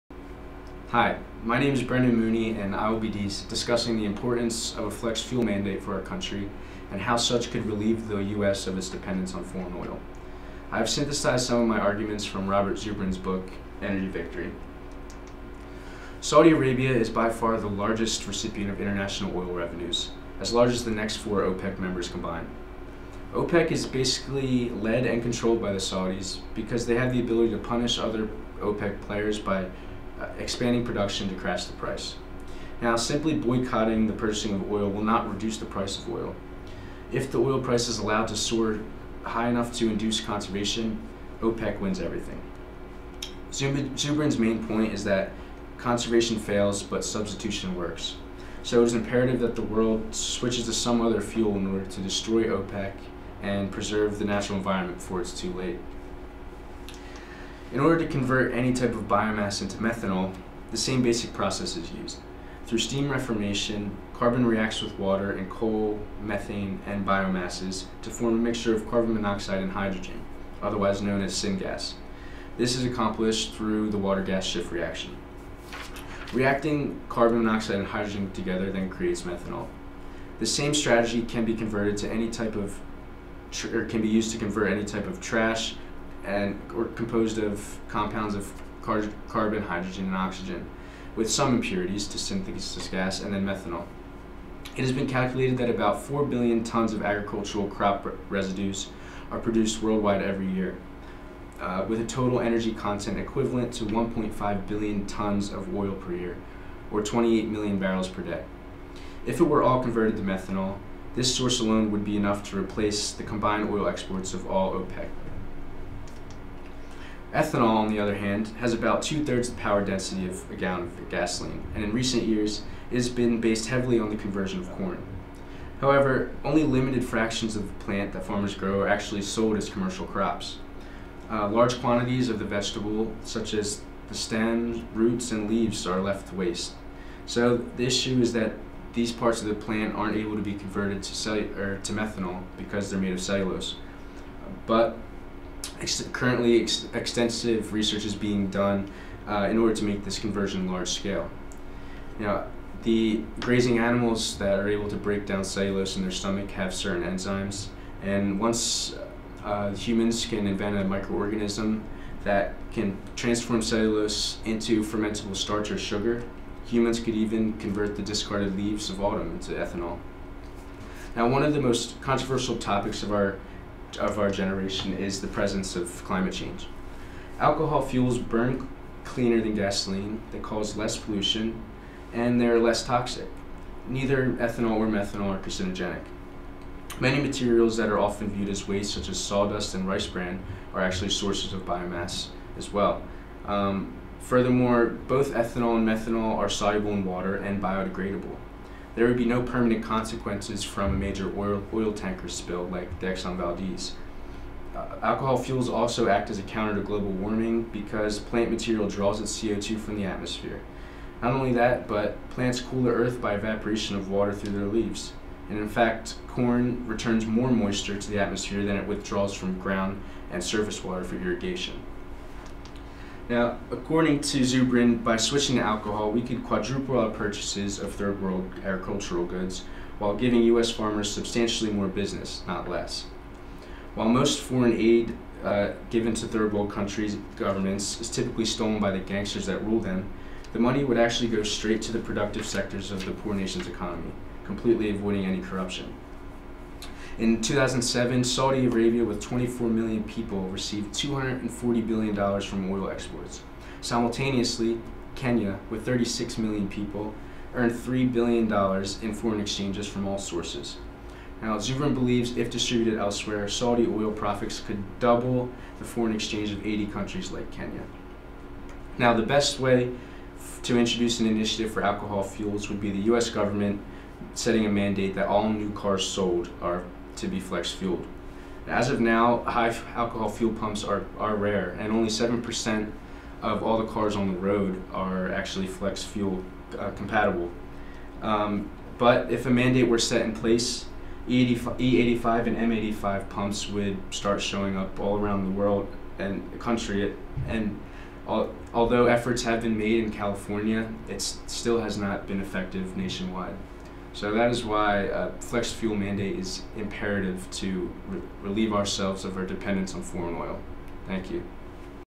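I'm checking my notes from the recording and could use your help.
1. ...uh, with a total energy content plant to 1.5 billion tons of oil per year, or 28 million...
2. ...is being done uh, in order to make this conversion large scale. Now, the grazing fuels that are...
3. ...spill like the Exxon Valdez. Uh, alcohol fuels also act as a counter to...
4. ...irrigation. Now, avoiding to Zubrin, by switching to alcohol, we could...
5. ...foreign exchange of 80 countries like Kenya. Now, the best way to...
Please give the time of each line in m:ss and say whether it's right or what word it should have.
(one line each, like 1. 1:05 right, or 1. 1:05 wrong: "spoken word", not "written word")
1. 1:41 wrong: "equivalent", not "plant"
2. 2:28 wrong: "animals", not "fuels"
3. 3:22 right
4. 3:41 wrong: "according", not "avoiding"
5. 4:25 right.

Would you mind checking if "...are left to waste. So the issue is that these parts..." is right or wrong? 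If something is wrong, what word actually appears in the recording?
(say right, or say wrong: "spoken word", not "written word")
right.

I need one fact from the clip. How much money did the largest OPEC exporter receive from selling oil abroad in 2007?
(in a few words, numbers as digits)
$240 billion.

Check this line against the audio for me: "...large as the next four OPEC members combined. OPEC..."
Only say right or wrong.
right.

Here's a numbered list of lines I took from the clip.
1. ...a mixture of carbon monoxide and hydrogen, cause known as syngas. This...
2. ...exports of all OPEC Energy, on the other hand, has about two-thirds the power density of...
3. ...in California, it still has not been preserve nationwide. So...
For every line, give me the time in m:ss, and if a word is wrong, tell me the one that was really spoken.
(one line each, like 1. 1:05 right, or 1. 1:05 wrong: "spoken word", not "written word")
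1. 1:08 wrong: "otherwise", not "cause"
2. 1:53 wrong: "Ethanol", not "Energy"
3. 5:00 wrong: "effective", not "preserve".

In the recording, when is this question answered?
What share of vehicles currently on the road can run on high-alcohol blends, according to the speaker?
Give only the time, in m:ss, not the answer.
4:42.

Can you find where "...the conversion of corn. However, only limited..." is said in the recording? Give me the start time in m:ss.
2:04.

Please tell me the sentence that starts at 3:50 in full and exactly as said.
farmers substantially more business, not less.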